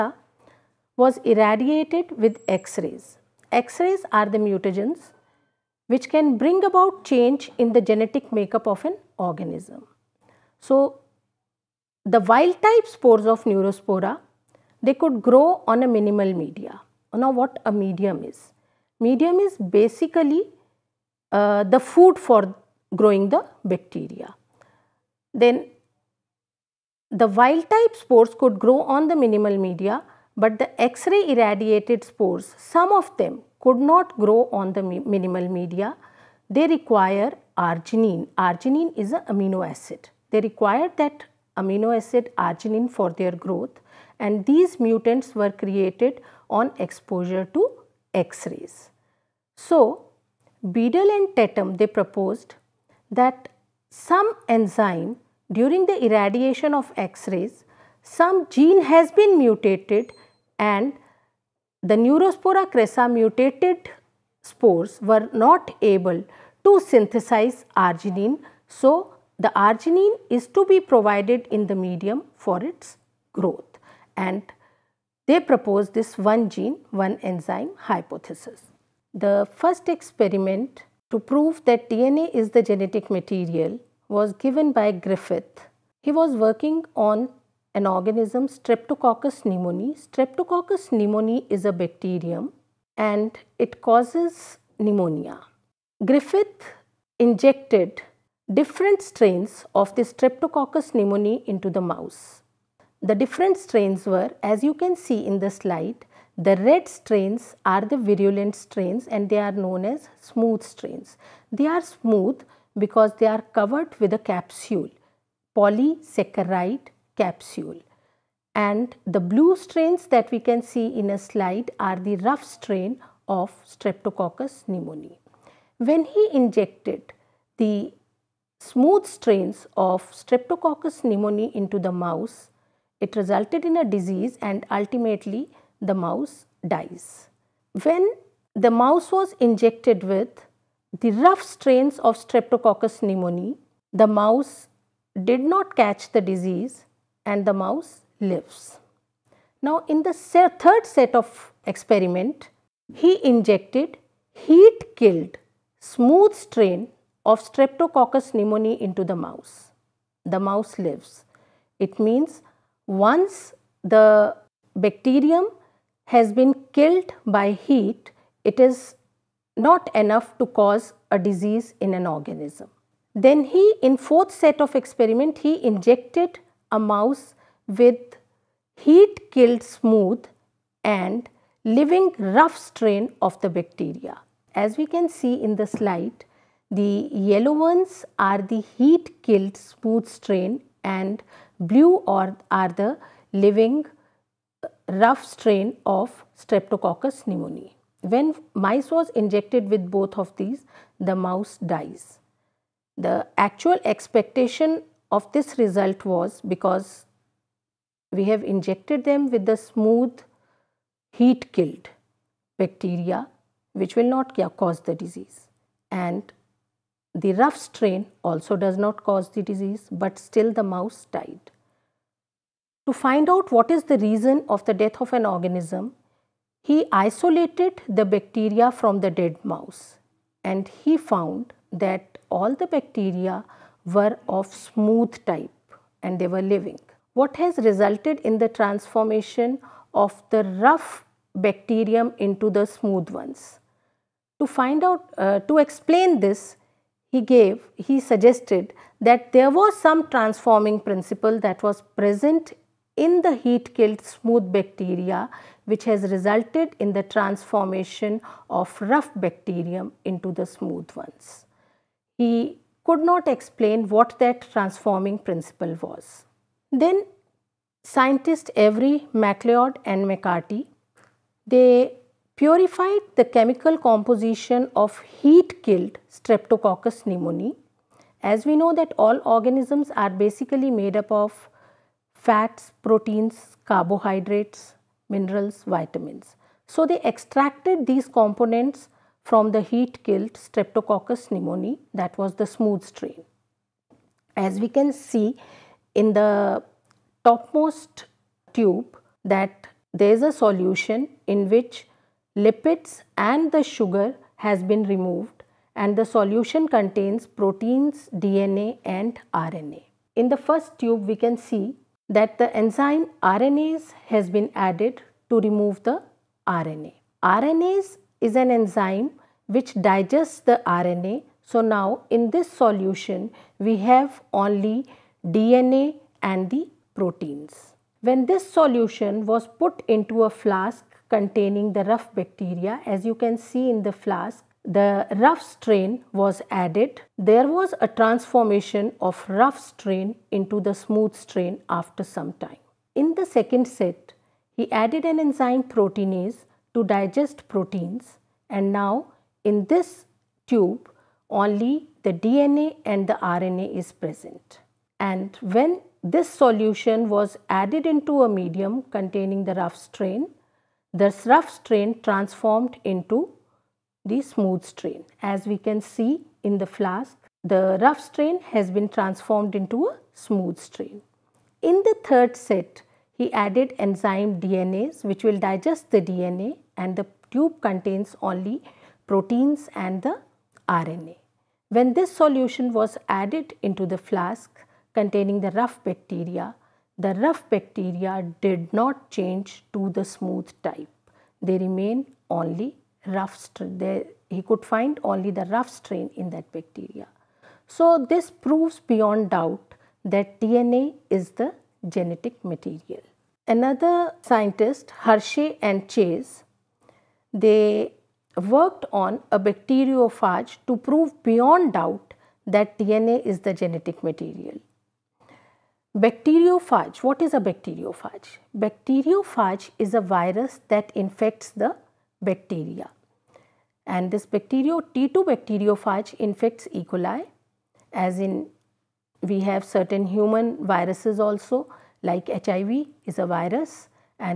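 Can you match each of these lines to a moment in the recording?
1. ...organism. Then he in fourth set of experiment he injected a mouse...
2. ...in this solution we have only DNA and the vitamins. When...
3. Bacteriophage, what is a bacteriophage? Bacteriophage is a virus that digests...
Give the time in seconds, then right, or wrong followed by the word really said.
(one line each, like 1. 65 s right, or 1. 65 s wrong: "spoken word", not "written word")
1. 172 s right
2. 322 s wrong: "proteins", not "vitamins"
3. 415 s wrong: "infects", not "digests".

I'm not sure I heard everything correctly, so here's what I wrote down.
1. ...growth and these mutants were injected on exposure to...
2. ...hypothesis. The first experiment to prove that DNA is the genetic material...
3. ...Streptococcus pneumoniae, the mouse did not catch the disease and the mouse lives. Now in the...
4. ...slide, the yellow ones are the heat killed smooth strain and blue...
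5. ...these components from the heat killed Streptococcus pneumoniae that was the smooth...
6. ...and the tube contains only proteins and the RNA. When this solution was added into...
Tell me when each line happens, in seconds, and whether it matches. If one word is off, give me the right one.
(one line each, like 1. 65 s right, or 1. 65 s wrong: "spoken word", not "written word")
1. 43 s wrong: "created", not "injected"
2. 77 s right
3. 142 s right
4. 185 s right
5. 287 s right
6. 376 s right.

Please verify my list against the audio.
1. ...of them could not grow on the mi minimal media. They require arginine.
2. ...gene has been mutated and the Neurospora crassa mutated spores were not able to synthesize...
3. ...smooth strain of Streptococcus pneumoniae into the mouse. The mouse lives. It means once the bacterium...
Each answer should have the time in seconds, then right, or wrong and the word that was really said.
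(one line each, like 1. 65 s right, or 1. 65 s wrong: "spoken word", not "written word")
1. 32 s right
2. 58 s right
3. 155 s right.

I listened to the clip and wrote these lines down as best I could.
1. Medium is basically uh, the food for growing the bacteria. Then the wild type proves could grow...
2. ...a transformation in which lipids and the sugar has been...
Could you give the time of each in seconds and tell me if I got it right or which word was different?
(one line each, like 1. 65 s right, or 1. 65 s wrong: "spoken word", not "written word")
1. 18 s wrong: "spores", not "proves"
2. 300 s wrong: "solution", not "transformation".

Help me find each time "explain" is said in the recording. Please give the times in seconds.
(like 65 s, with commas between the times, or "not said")
245 s, 263 s.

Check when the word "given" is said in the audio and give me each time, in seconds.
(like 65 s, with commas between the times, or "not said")
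84 s.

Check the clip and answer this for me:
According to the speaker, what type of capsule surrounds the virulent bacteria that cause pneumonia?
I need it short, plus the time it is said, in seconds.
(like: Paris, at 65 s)
Polysaccharide capsule, at 115 s.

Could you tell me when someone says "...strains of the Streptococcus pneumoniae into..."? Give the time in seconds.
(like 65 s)
99 s.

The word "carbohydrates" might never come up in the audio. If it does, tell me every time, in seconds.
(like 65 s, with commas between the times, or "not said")
283 s.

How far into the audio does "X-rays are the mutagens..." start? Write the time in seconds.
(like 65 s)
3 s.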